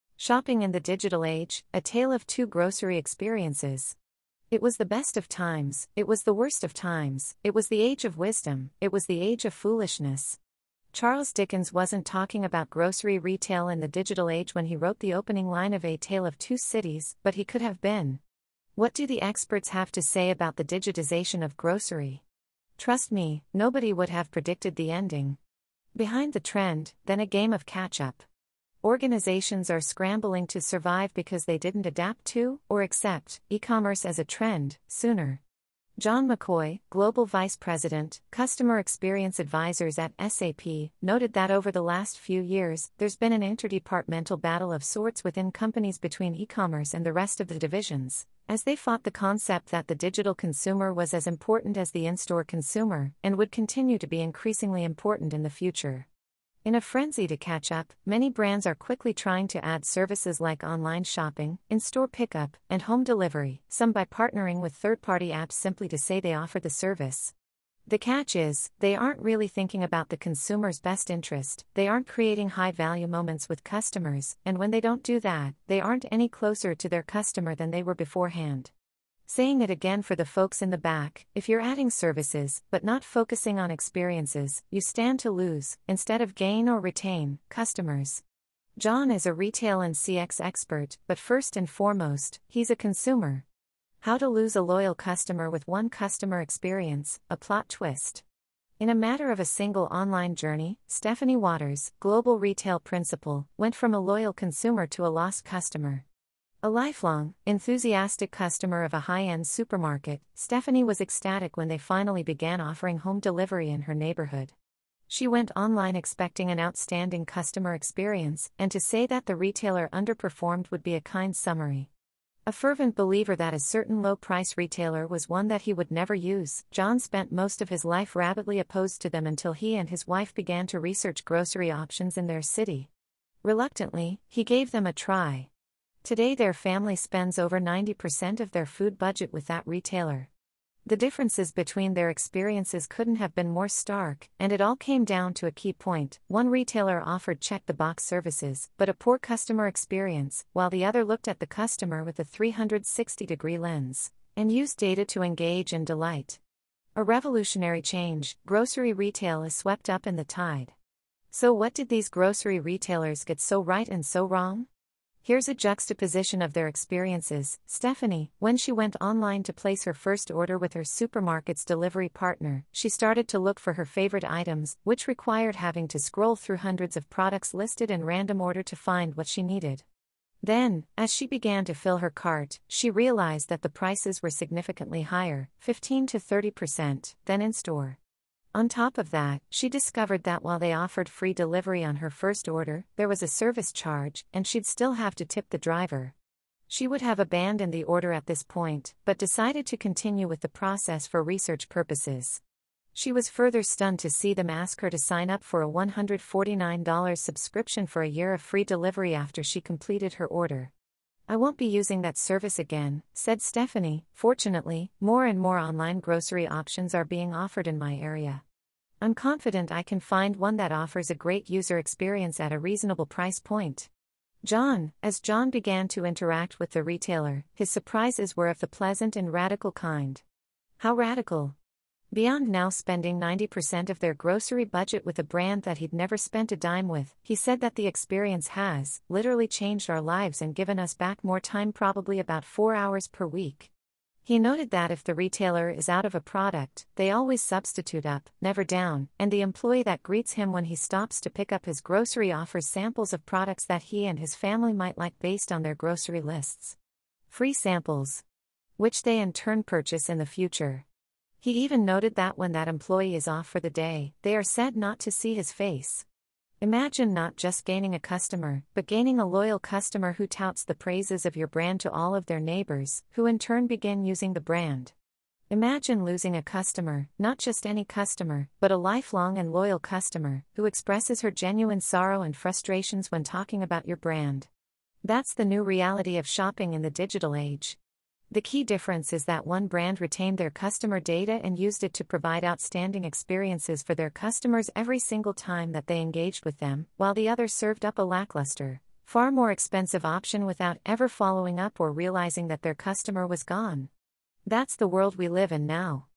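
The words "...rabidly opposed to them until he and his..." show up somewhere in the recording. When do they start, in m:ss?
2:08.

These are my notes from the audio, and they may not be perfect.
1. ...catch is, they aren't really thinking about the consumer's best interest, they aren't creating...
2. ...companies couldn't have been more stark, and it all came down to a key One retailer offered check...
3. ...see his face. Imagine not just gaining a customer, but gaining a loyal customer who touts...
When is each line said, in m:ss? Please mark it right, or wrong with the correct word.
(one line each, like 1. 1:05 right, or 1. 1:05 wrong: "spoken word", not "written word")
1. 1:07 right
2. 2:22 wrong: "experiences", not "companies"
3. 4:25 right.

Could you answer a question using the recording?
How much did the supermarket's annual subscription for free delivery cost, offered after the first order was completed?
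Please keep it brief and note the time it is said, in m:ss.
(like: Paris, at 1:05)
$149, at 3:25.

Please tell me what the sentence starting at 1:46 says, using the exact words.
A lifelong, enthusiastic customer of a high end supermarket, Stephanie was ecstatic when they finally began offering home delivery in her neighborhood.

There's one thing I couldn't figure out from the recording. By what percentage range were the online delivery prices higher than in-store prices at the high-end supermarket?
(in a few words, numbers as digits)
15 to 30%.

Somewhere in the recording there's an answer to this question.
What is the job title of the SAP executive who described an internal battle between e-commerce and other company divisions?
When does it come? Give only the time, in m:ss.
0:36.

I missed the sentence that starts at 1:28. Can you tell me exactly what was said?
John is a retail and CX expert, but first and foremost, he's a consumer.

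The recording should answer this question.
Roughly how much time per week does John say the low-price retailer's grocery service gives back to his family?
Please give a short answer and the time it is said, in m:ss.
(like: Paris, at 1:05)
4 hours, at 4:02.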